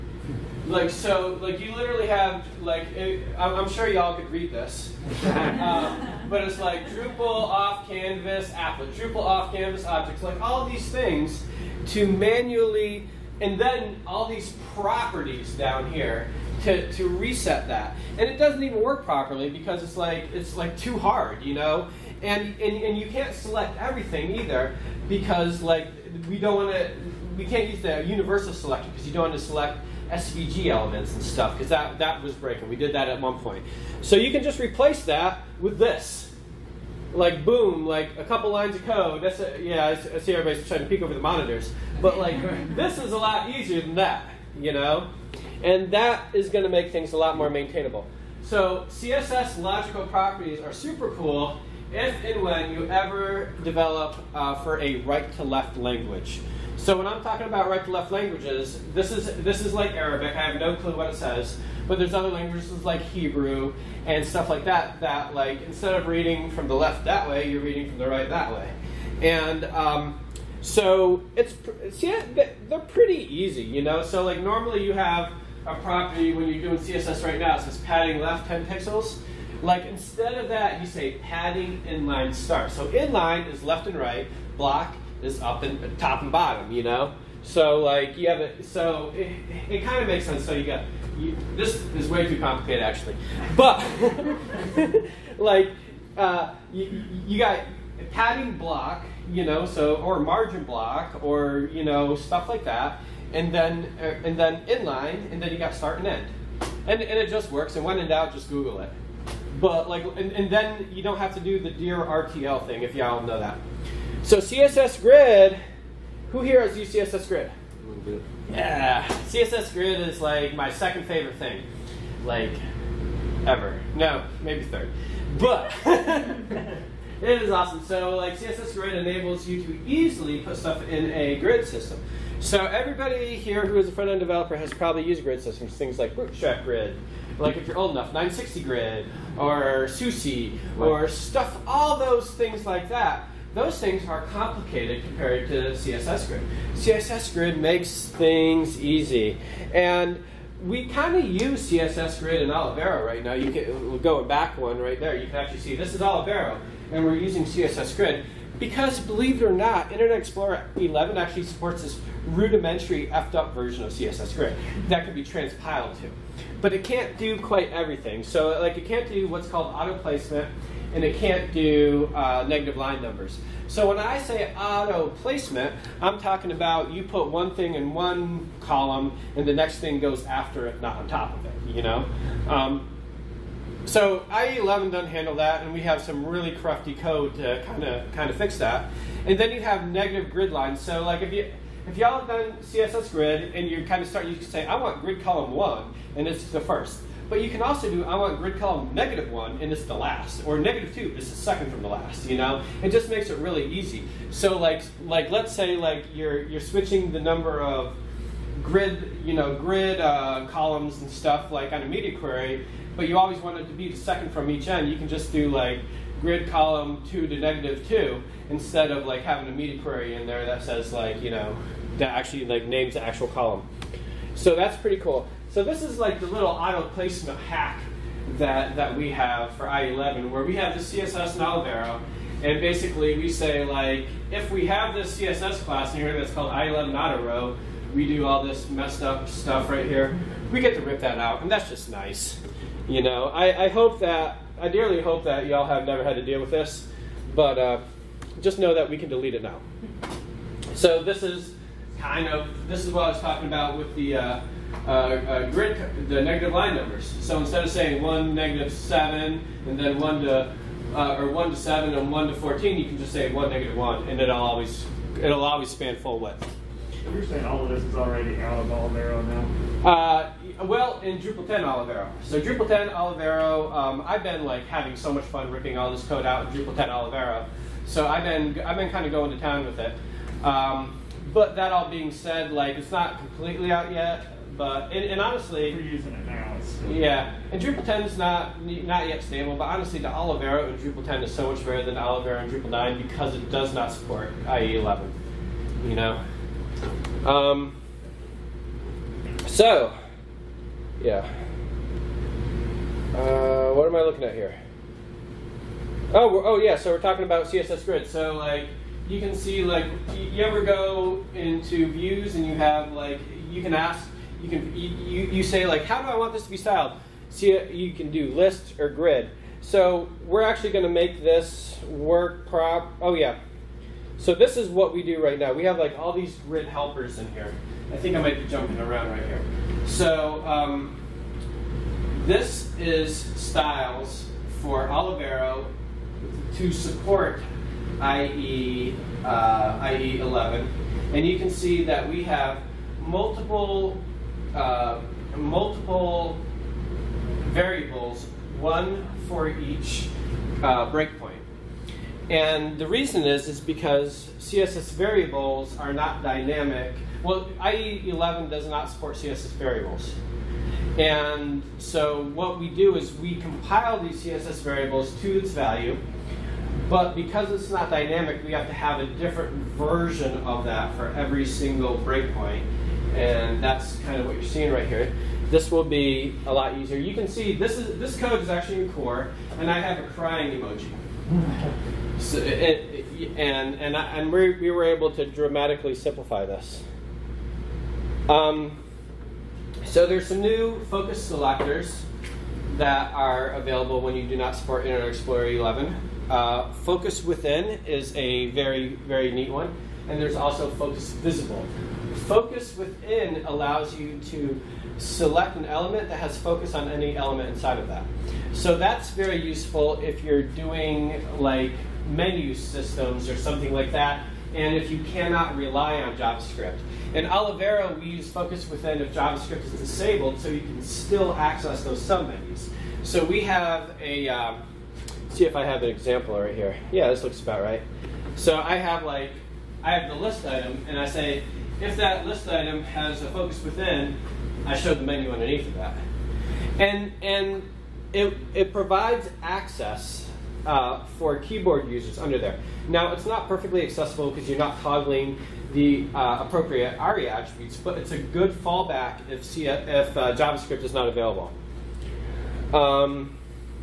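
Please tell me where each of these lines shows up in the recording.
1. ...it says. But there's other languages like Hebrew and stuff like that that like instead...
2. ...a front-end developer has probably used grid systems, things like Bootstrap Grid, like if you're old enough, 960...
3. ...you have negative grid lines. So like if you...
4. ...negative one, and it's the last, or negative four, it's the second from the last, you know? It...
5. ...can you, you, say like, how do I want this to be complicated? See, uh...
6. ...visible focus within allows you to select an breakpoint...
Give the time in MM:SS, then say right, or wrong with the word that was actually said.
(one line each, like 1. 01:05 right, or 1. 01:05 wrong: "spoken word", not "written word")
1. 01:01 right
2. 02:13 right
3. 03:09 right
4. 03:18 wrong: "two", not "four"
5. 05:14 wrong: "styled", not "complicated"
6. 06:41 wrong: "element", not "breakpoint".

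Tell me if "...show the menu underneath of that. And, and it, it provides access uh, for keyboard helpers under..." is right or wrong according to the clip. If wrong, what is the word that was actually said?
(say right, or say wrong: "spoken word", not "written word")
wrong: "users", not "helpers".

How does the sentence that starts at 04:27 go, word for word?
you're saying all of this is already out of Olivero now?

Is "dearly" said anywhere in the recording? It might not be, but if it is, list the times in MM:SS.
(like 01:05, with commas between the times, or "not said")
04:04.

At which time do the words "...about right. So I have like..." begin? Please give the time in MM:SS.
07:07.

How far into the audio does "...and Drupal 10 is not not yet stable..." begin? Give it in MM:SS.
04:47.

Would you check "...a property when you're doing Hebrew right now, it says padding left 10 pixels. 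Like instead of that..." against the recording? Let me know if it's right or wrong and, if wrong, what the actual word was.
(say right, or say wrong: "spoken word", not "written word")
wrong: "CSS", not "Hebrew".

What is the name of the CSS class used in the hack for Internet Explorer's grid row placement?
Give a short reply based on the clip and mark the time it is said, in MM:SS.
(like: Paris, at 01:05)
I-11 auto row, at 03:56.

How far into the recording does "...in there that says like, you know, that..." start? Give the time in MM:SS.
03:40.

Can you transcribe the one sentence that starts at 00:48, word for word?
So CSS logical properties are super cool if and when you ever develop uh, for a right-to-left language.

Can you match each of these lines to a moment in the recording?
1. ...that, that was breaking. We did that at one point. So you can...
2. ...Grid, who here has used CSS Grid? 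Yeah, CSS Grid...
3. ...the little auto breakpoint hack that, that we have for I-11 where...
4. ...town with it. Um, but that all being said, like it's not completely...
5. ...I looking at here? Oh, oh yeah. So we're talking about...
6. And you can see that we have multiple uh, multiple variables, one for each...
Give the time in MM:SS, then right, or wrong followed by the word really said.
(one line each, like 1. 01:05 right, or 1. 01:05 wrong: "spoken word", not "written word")
1. 00:31 right
2. 01:55 right
3. 03:46 wrong: "placement", not "breakpoint"
4. 04:39 right
5. 05:03 right
6. 05:41 right.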